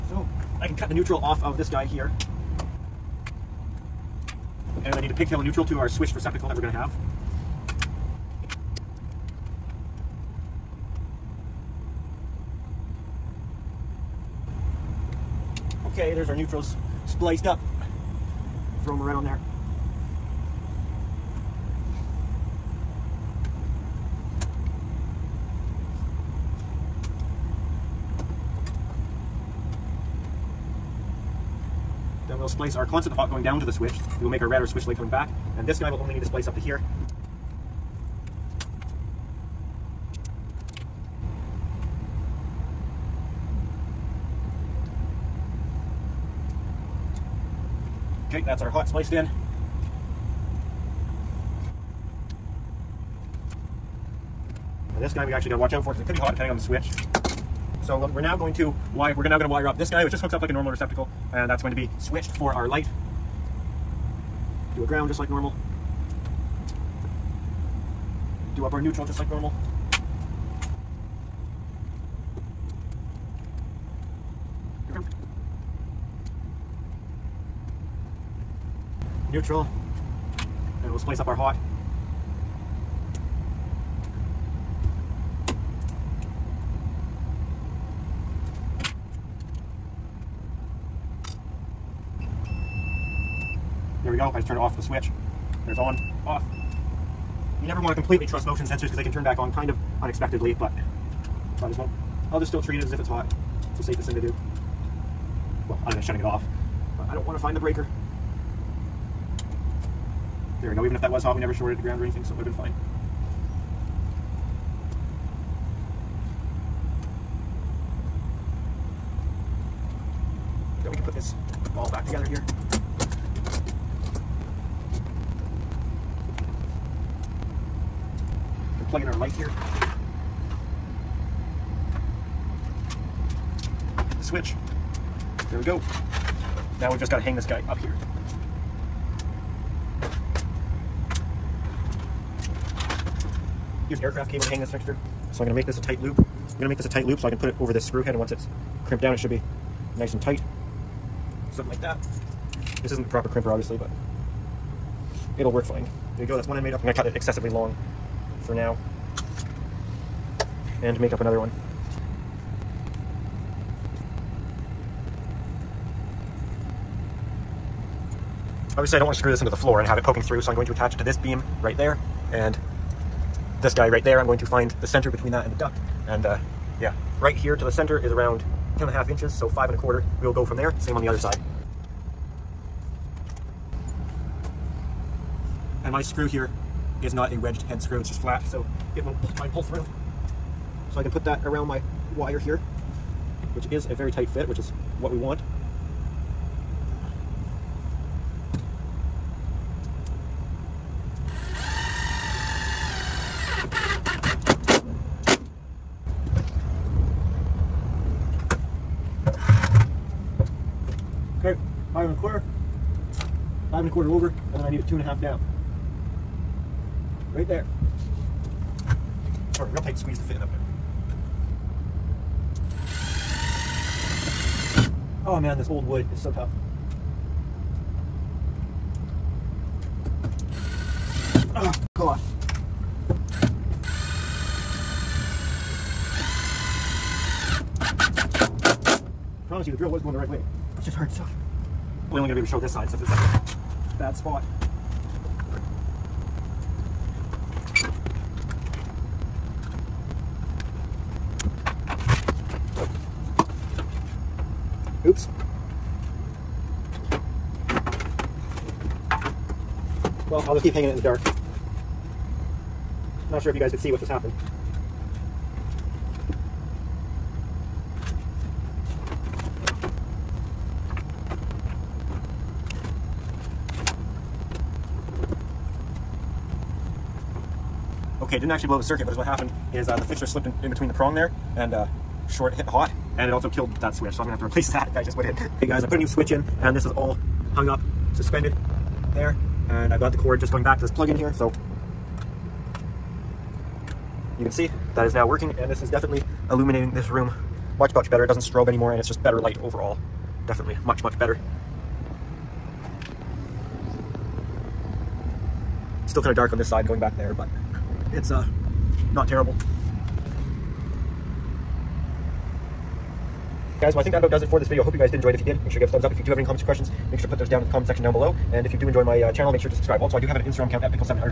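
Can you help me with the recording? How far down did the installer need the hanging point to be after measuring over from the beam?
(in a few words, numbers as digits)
2.5 inches.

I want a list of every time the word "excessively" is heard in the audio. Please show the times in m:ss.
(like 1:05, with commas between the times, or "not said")
2:37.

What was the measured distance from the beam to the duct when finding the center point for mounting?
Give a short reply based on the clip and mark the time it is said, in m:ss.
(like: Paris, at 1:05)
10.5 inches, at 2:58.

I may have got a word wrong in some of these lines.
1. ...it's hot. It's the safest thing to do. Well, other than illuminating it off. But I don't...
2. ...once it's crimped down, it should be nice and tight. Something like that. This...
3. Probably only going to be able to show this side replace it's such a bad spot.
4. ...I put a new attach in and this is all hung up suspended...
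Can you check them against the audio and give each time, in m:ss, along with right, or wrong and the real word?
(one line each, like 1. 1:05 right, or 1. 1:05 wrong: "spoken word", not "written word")
1. 1:42 wrong: "shutting", not "illuminating"
2. 2:28 right
3. 4:02 wrong: "since", not "replace"
4. 4:45 wrong: "switch", not "attach".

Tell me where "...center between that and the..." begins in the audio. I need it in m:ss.
2:54.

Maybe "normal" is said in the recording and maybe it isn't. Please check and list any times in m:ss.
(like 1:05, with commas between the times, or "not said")
1:00, 1:05, 1:09.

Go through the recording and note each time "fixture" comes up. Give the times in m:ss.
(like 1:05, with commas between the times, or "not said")
2:24, 4:40.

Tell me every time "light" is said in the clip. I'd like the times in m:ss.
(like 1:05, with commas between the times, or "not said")
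1:02, 2:09, 4:59.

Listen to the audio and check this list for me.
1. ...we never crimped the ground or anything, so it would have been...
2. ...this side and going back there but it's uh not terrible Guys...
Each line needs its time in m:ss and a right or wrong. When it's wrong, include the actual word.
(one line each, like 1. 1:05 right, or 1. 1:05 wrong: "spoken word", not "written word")
1. 1:51 wrong: "shorted", not "crimped"
2. 5:06 right.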